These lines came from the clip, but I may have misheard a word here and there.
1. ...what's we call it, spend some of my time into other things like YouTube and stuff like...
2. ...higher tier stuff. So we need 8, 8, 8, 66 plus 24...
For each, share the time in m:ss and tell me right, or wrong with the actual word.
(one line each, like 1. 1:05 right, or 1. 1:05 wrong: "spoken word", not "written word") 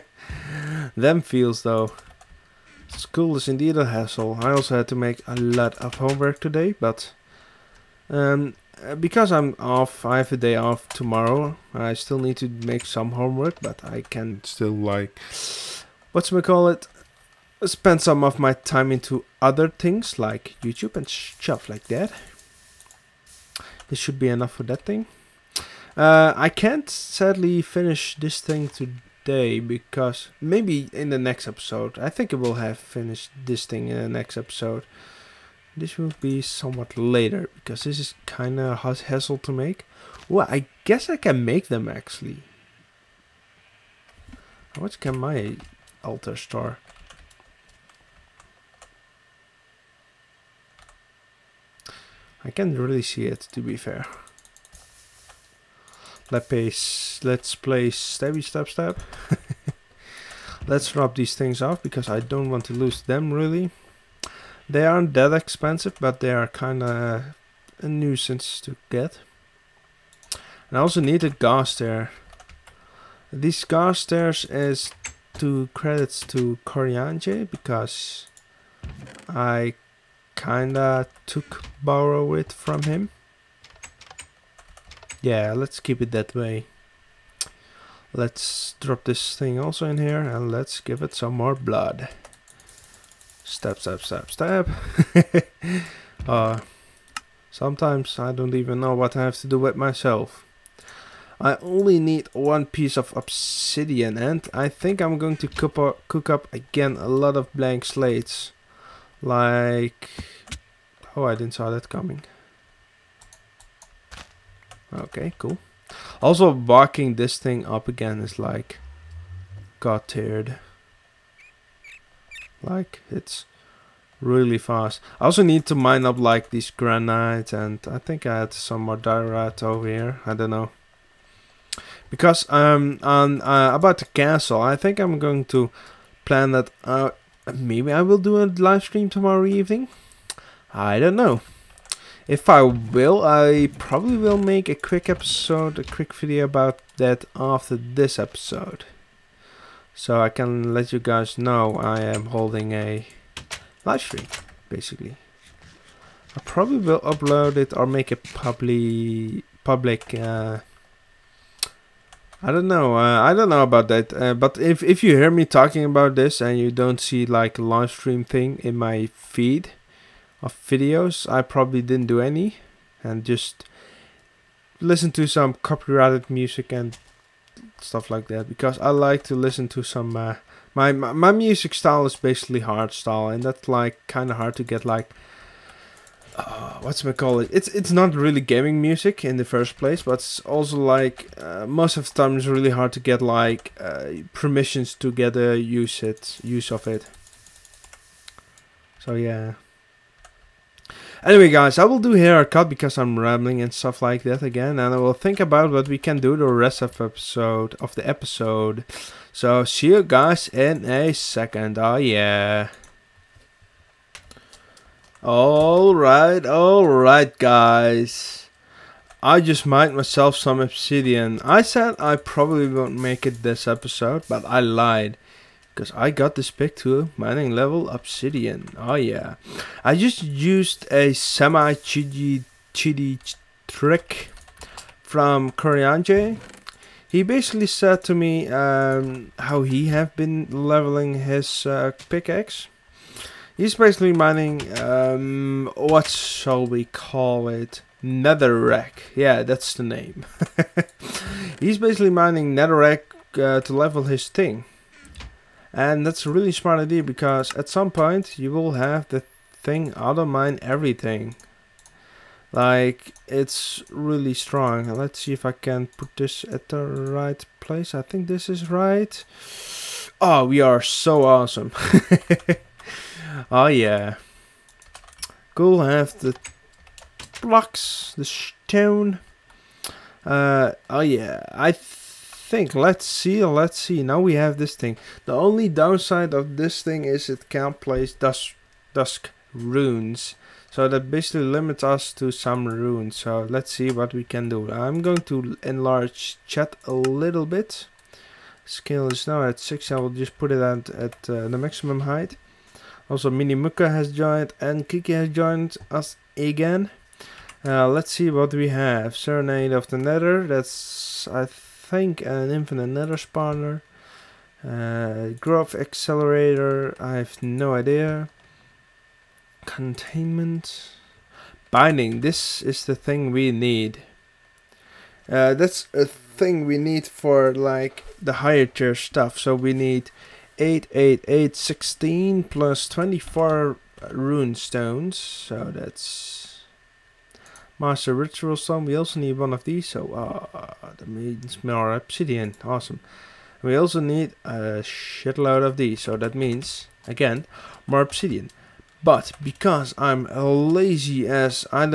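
1. 0:16 right
2. 5:28 wrong: "16", not "66".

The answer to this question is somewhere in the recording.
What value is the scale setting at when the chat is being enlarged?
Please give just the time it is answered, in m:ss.
4:59.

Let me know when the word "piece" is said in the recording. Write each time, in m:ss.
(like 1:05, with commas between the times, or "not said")
1:42.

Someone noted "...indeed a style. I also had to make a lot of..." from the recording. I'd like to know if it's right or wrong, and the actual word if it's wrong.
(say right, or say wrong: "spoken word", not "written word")
wrong: "hassle", not "style".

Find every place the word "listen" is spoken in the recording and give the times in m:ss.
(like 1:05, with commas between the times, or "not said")
2:54, 2:59.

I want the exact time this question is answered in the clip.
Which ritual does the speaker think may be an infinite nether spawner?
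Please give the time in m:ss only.
5:09.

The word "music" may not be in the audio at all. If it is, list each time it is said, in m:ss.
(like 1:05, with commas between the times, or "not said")
2:56, 3:01, 3:08.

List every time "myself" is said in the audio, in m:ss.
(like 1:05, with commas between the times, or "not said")
1:39, 3:39.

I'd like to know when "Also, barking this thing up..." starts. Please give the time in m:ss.
1:56.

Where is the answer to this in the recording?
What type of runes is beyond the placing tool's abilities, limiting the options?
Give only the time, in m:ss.
4:48.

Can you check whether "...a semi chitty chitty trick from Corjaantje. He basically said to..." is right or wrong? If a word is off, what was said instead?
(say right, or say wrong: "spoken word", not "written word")
right.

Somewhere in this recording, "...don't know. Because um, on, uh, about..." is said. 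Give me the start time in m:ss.
2:10.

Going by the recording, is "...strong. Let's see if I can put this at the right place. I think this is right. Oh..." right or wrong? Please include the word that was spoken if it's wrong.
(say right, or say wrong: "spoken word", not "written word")
right.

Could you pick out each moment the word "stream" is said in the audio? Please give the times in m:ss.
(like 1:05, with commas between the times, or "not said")
2:18, 2:34, 2:47.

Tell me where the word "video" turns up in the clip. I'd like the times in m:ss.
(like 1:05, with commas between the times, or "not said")
2:26, 2:50.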